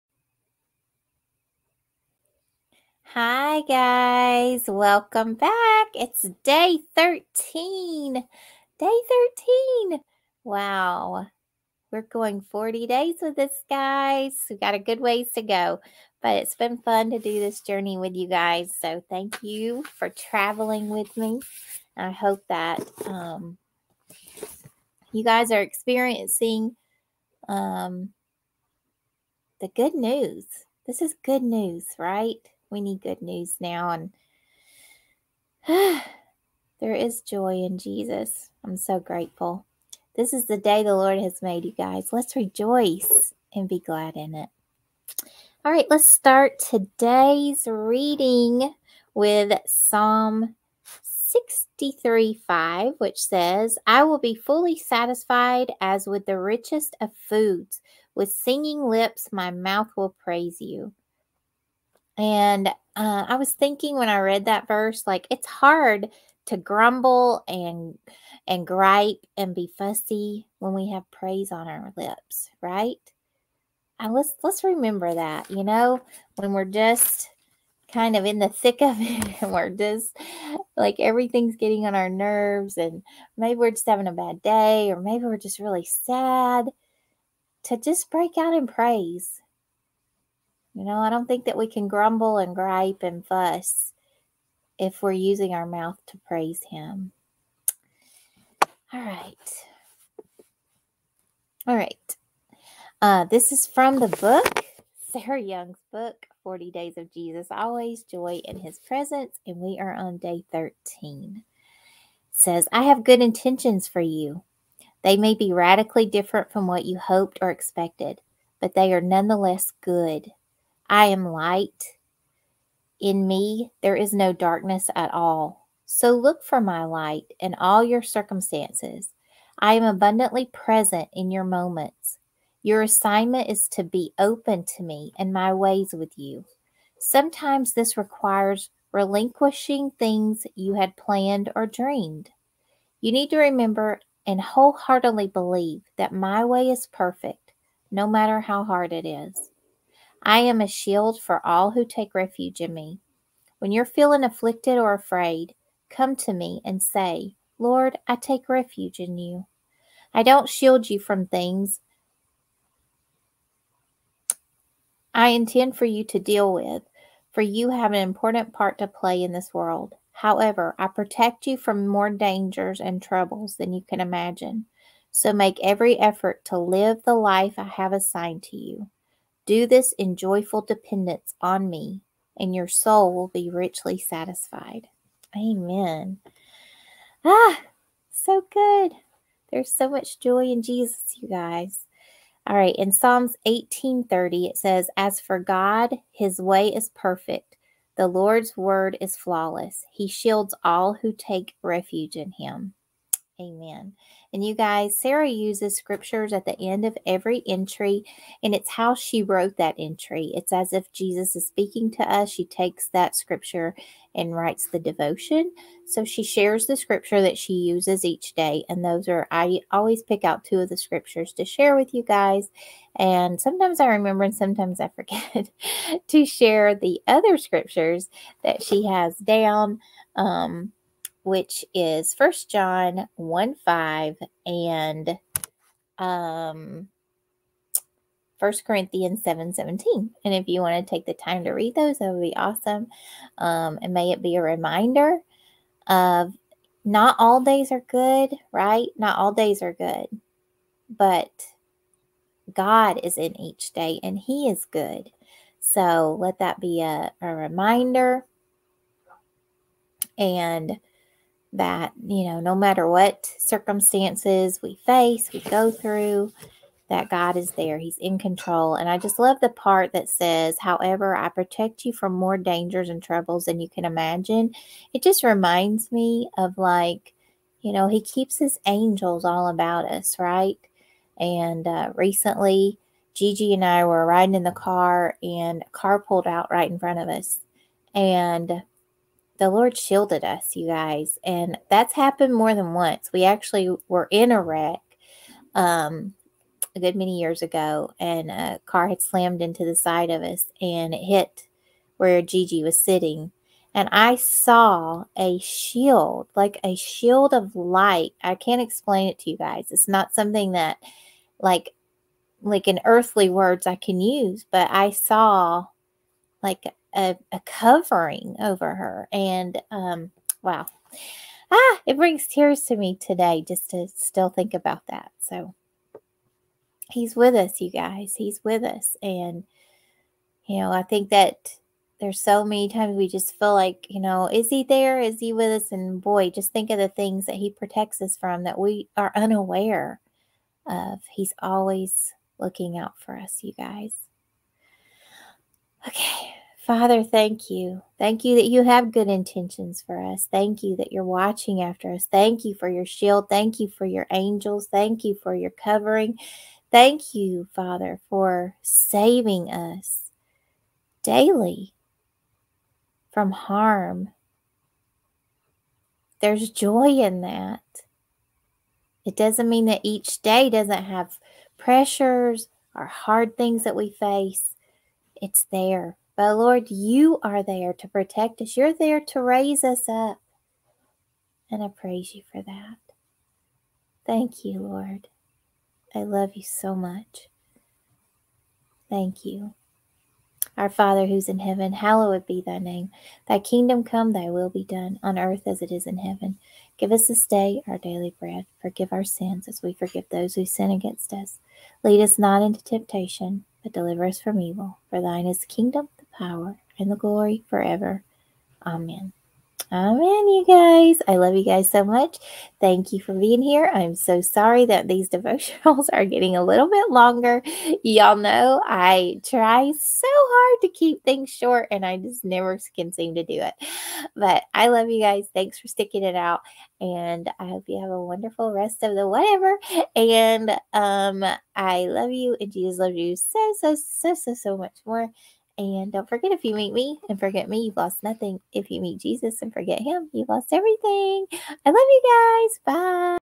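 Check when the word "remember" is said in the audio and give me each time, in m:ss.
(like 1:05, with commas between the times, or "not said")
1:14, 2:23, 3:43.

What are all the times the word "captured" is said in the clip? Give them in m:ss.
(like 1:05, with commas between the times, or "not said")
not said.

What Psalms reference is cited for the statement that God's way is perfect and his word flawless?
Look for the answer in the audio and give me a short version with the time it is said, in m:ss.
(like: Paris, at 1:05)
Psalms 18:30, at 3:12.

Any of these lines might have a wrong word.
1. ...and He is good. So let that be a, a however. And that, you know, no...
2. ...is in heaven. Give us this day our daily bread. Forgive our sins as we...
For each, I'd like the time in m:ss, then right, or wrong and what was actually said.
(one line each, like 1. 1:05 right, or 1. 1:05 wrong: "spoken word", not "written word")
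1. 4:14 wrong: "reminder", not "however"
2. 6:35 right.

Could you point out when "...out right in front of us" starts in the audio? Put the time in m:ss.
4:46.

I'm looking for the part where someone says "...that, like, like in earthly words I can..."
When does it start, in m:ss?
5:10.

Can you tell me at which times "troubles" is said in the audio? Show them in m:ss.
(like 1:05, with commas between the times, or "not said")
2:53, 4:33.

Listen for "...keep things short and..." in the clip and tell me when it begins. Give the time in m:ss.
7:00.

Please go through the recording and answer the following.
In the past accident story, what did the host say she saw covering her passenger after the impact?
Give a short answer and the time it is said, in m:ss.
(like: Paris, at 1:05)
a shield of light, at 5:06.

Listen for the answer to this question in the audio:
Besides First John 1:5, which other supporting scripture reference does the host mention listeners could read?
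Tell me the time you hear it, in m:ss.
3:58.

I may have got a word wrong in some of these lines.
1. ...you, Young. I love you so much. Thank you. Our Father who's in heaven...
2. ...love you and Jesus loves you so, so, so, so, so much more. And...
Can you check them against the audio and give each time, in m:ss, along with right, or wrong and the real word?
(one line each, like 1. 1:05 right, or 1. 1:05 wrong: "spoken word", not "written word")
1. 6:24 wrong: "Lord", not "Young"
2. 7:11 right.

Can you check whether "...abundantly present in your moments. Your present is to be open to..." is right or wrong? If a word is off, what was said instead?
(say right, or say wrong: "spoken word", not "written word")
wrong: "assignment", not "present".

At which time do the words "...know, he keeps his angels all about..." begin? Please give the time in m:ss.
4:37.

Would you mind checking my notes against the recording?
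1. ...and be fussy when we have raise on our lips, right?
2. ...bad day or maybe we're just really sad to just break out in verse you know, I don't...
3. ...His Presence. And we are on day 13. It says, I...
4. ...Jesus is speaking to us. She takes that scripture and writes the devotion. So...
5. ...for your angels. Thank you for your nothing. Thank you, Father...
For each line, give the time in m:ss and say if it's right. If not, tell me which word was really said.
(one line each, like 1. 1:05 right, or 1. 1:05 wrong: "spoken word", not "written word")
1. 1:09 wrong: "praise", not "raise"
2. 1:24 wrong: "praise", not "verse"
3. 1:48 right
4. 3:30 right
5. 5:53 wrong: "covering", not "nothing".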